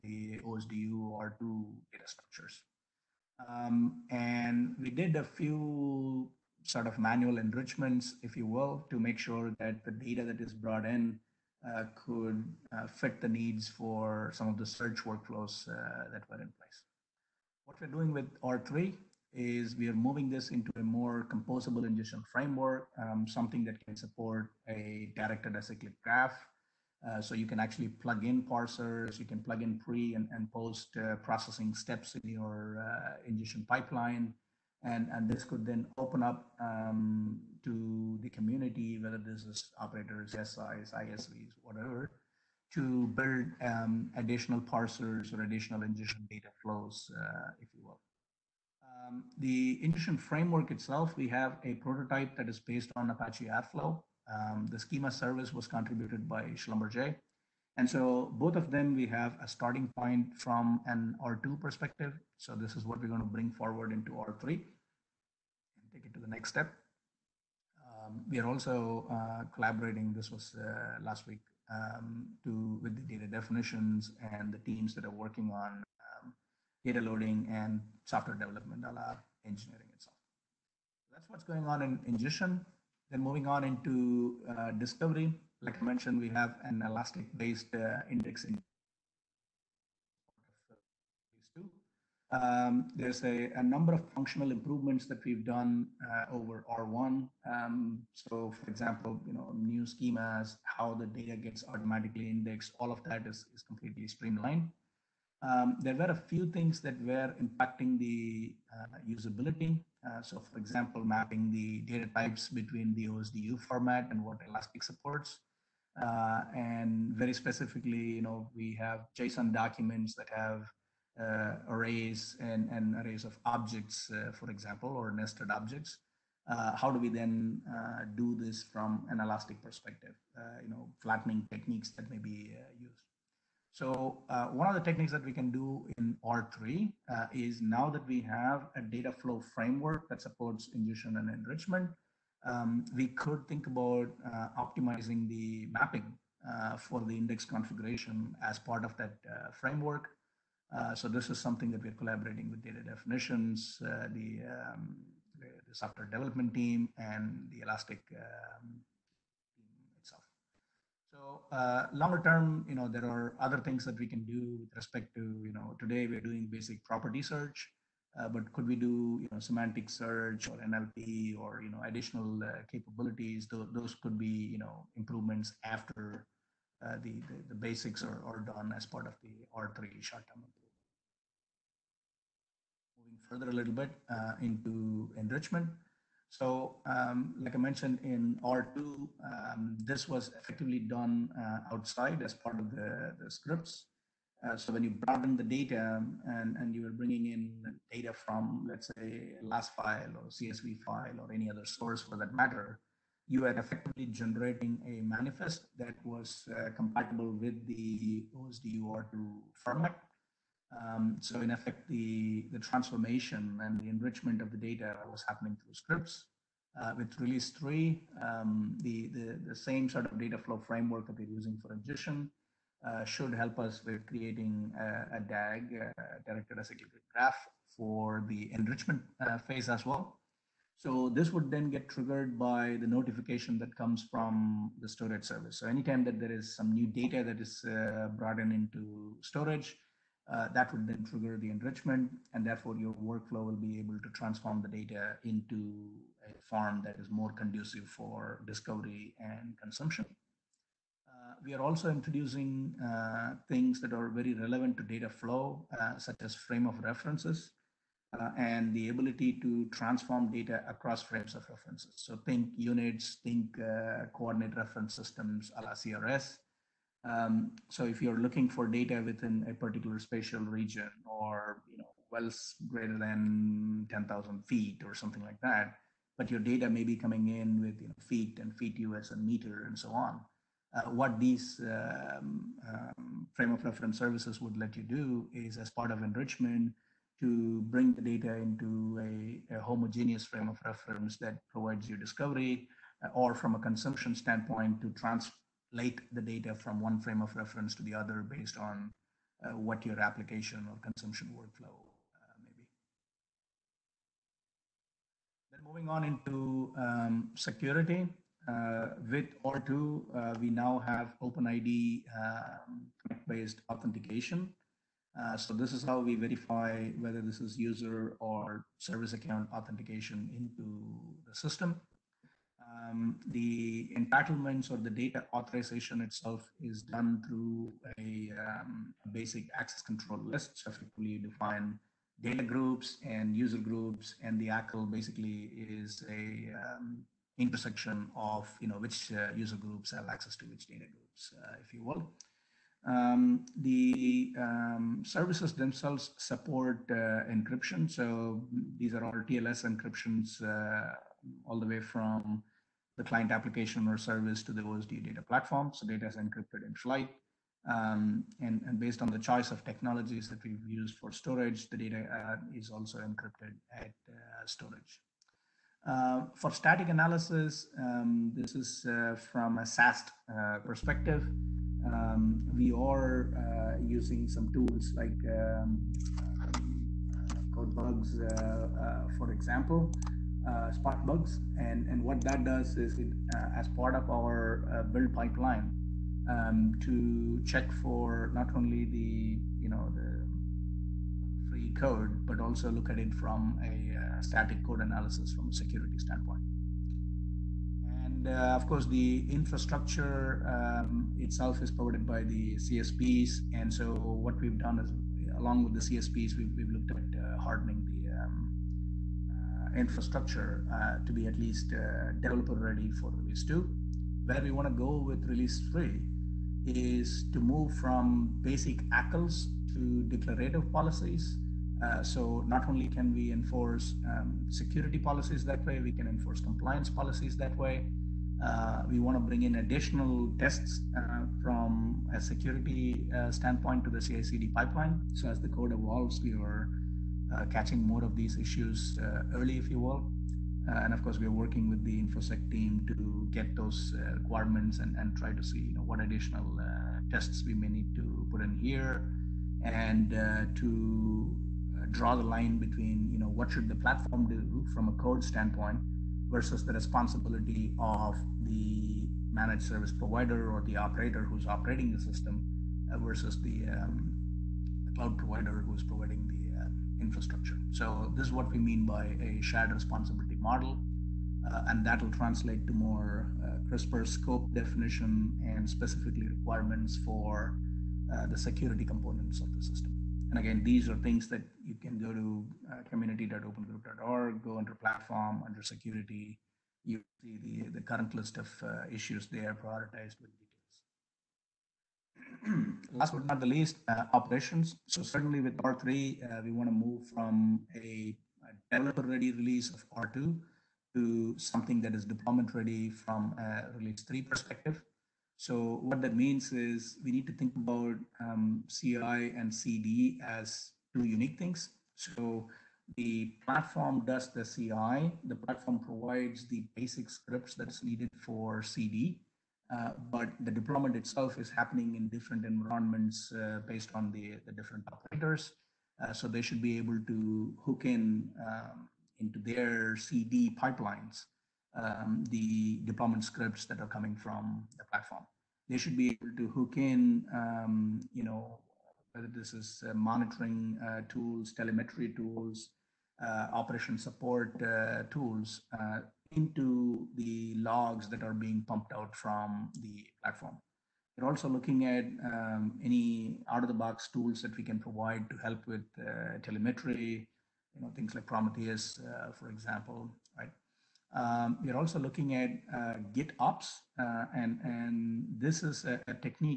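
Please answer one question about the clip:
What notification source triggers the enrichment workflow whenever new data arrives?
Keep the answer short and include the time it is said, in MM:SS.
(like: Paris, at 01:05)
storage service, at 03:54.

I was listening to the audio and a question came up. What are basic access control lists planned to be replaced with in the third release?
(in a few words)
declarative policies.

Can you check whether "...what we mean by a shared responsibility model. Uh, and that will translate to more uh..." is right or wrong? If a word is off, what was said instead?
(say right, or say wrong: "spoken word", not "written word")
right.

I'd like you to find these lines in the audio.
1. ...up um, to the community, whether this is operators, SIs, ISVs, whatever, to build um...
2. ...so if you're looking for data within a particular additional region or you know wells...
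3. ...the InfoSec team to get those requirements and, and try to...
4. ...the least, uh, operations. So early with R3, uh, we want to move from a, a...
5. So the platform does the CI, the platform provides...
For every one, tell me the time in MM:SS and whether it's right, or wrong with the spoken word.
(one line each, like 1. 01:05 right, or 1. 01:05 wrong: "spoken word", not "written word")
1. 00:36 right
2. 04:27 wrong: "spatial", not "additional"
3. 07:21 right
4. 08:13 wrong: "certainly", not "early"
5. 08:31 right.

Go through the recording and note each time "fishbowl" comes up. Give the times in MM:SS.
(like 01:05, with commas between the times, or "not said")
not said.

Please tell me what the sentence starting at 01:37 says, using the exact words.
Um, so, for example, you know, new schemas, how the data gets automatically indexed, all of that is, is completely streamlined.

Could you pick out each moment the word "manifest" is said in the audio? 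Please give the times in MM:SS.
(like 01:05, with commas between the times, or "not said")
03:25.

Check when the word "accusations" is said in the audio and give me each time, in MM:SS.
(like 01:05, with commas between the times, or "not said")
not said.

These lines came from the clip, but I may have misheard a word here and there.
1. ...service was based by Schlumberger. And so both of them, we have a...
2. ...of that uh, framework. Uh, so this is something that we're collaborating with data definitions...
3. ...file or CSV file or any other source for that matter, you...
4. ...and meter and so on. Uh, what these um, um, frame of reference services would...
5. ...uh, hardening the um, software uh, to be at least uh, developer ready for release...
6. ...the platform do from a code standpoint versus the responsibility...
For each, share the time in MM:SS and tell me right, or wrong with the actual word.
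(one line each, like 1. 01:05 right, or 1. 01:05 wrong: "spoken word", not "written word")
1. 00:55 wrong: "contributed", not "based"
2. 02:28 right
3. 03:19 right
4. 04:39 right
5. 06:47 wrong: "infrastructure", not "software"
6. 07:33 right.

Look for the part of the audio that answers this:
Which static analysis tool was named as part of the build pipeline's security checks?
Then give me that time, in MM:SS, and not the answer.
06:20.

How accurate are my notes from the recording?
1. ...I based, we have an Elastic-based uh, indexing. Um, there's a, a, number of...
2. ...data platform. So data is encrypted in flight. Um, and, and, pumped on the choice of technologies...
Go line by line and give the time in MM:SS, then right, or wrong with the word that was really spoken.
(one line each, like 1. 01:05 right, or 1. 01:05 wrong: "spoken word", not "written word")
1. 01:25 wrong: "mentioned", not "based"
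2. 05:55 wrong: "based", not "pumped".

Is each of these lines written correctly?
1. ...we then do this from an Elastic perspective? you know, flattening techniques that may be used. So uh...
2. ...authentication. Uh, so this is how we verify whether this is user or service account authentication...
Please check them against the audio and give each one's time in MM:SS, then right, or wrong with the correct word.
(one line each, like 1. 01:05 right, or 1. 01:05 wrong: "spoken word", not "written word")
1. 02:06 right
2. 05:13 right.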